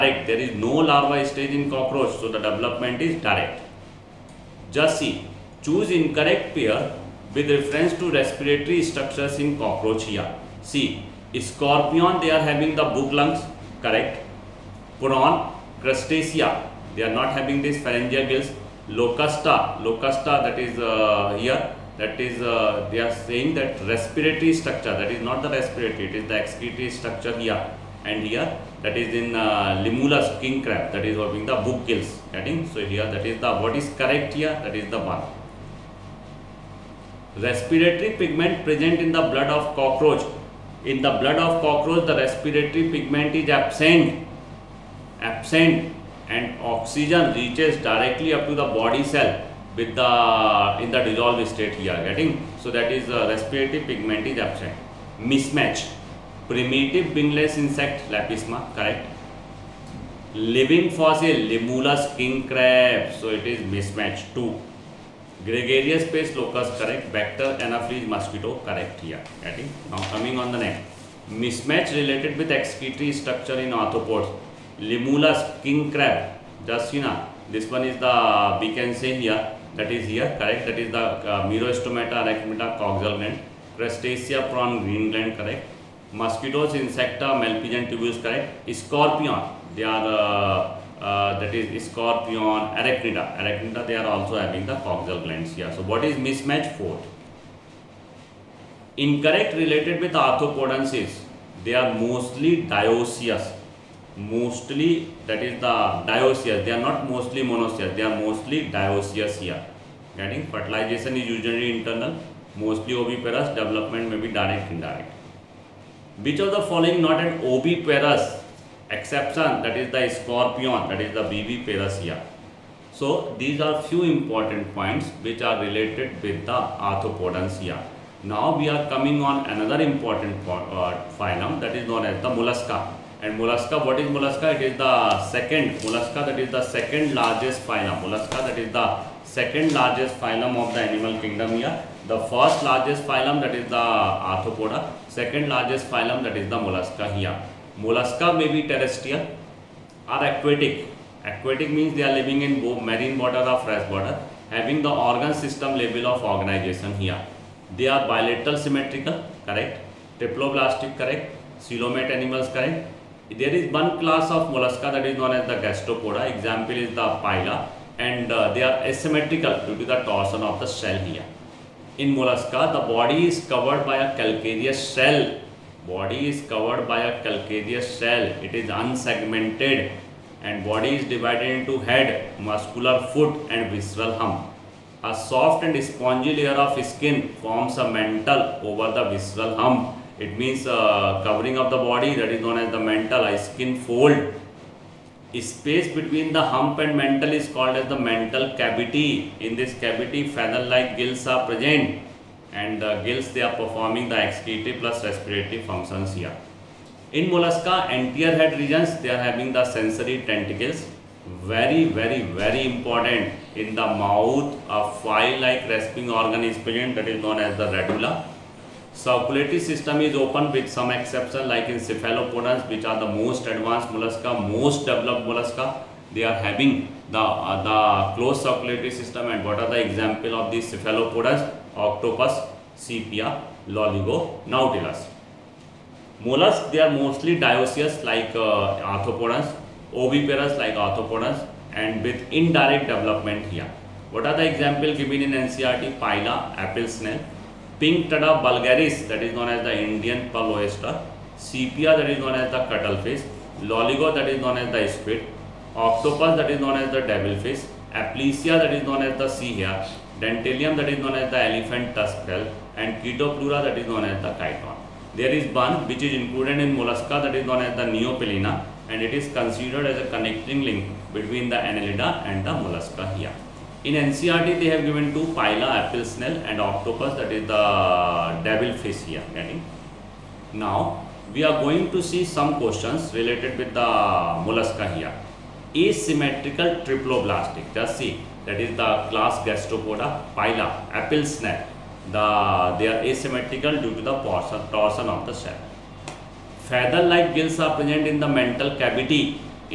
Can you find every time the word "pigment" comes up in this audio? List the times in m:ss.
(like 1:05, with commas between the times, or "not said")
0:38, 0:42, 0:53.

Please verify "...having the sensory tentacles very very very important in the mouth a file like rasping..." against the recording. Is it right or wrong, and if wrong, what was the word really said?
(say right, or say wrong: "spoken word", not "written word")
right.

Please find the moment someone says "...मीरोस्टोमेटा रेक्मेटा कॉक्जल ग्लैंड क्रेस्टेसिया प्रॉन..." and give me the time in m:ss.
1:21.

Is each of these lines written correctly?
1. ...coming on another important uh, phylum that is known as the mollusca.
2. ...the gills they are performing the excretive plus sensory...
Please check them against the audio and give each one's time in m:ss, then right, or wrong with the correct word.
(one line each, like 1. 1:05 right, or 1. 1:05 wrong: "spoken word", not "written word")
1. 2:08 right
2. 3:22 wrong: "respiratory", not "sensory".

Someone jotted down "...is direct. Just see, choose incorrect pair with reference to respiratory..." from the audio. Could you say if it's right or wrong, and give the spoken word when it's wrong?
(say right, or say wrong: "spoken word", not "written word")
right.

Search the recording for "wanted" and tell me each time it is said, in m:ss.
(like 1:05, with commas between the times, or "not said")
not said.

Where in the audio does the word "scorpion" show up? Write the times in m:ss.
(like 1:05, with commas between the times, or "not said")
0:11, 1:31, 2:00.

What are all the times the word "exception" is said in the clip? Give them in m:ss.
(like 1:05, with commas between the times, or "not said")
1:58, 3:40.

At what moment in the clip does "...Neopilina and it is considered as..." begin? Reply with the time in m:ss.
4:27.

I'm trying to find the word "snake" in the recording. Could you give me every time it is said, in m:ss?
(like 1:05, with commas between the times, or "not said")
4:51.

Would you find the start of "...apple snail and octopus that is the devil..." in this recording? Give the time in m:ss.
4:35.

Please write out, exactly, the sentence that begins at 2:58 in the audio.
It is unsegmented and body is divided into head, muscular foot and visceral hump.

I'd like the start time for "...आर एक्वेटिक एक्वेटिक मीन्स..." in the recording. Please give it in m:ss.
2:30.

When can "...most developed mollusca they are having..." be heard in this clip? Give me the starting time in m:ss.
3:44.